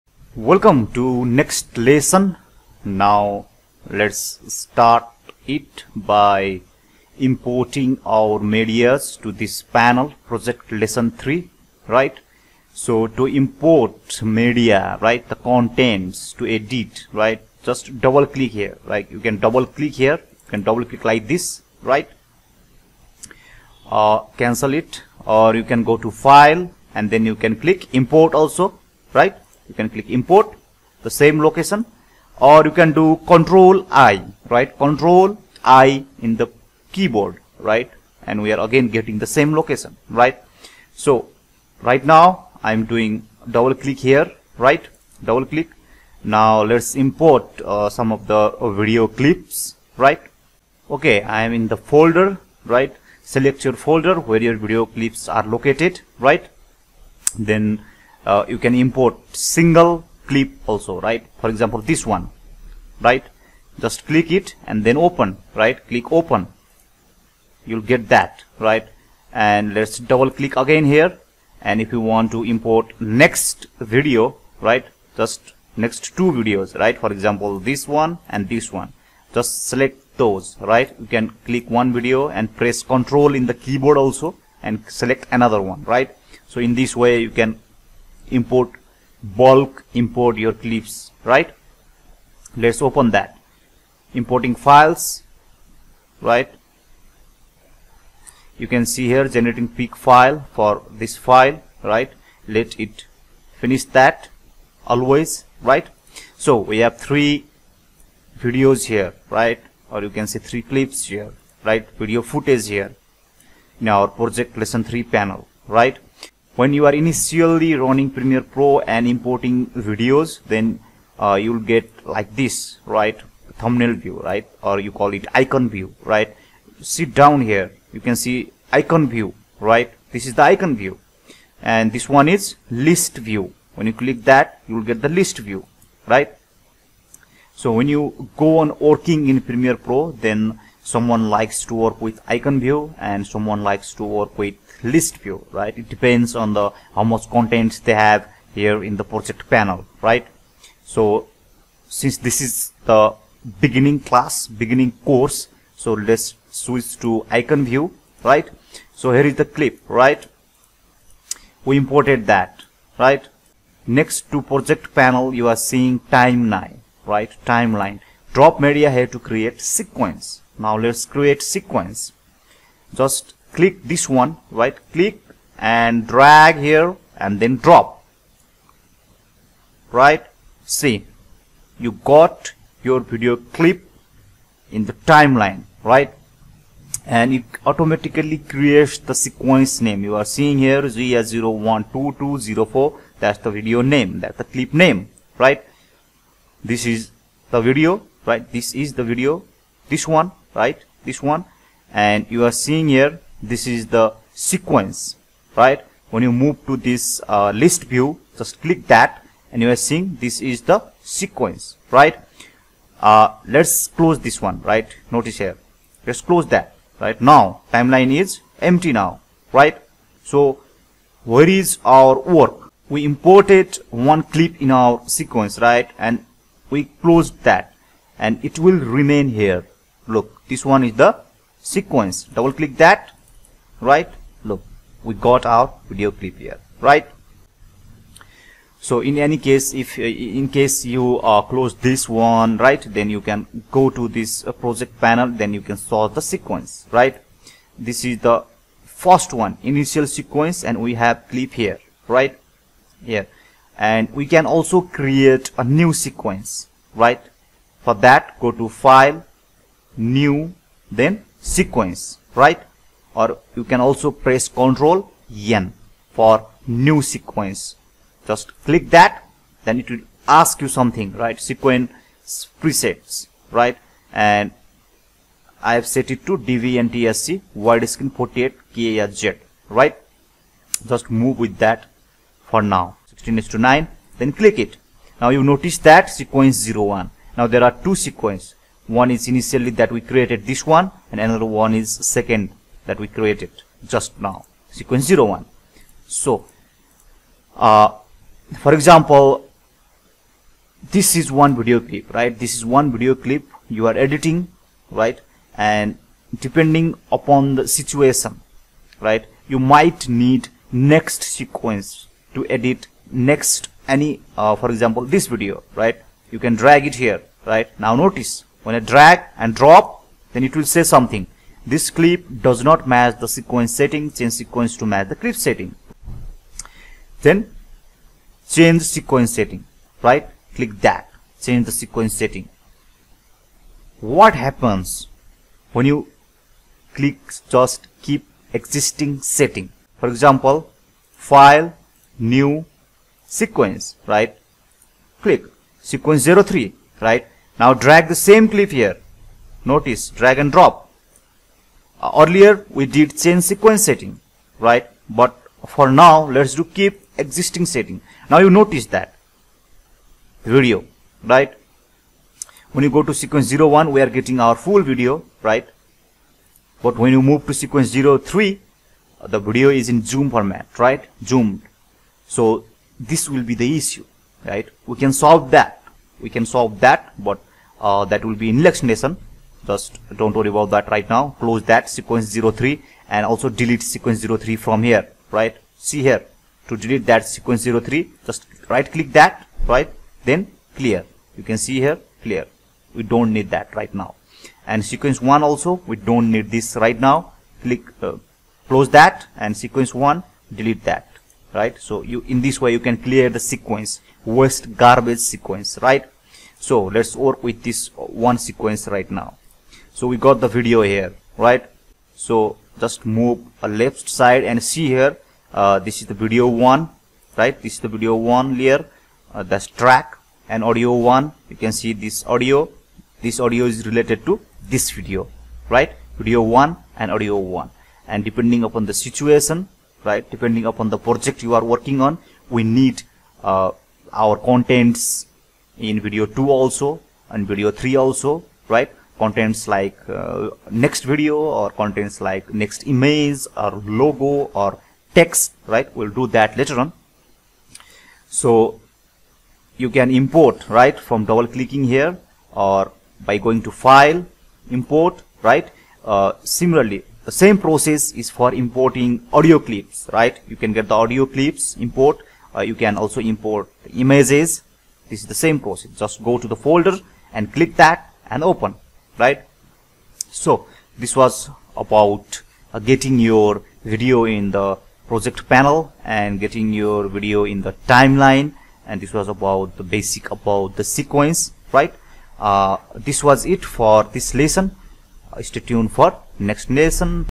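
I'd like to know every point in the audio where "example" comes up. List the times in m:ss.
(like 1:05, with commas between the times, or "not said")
1:01, 1:17, 4:58, 5:14, 5:40.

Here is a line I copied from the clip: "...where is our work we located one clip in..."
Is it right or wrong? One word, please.
wrong.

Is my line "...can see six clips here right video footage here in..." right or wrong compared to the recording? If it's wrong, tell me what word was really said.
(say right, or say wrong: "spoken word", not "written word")
wrong: "three", not "six".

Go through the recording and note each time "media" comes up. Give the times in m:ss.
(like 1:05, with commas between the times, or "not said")
0:08, 0:14, 2:48.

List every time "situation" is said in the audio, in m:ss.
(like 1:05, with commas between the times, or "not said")
5:07, 7:08.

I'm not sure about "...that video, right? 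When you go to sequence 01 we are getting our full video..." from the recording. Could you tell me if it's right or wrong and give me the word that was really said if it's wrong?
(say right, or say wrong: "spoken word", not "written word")
right.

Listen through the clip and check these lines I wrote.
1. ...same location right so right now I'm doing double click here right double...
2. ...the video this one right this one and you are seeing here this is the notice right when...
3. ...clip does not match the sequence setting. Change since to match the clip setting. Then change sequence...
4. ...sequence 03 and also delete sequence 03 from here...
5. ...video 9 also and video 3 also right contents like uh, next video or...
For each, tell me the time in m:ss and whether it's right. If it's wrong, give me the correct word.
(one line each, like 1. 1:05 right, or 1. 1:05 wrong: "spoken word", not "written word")
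1. 0:39 right
2. 3:18 wrong: "sequence", not "notice"
3. 5:21 wrong: "sequence", not "since"
4. 6:21 right
5. 7:15 wrong: "2", not "9".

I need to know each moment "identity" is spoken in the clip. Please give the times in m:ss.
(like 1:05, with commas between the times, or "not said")
not said.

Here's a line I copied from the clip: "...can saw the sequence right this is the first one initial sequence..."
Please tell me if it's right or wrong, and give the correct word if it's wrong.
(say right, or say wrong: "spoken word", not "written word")
right.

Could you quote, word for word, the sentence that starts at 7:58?
And this was about the basic about the sequence, right?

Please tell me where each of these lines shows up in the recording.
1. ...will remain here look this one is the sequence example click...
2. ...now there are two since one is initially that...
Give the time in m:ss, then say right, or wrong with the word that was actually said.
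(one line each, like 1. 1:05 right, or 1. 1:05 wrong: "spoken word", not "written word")
1. 3:48 wrong: "double", not "example"
2. 4:47 wrong: "sequence", not "since".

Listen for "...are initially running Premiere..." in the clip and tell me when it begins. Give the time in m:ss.
1:56.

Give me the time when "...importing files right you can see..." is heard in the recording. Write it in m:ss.
1:34.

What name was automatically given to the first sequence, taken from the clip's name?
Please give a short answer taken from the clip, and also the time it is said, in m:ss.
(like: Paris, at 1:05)
Z 12204, at 3:10.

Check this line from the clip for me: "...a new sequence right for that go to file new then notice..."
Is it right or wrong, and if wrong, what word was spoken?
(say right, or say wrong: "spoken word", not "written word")
wrong: "sequence", not "notice".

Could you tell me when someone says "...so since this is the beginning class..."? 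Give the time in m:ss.
2:30.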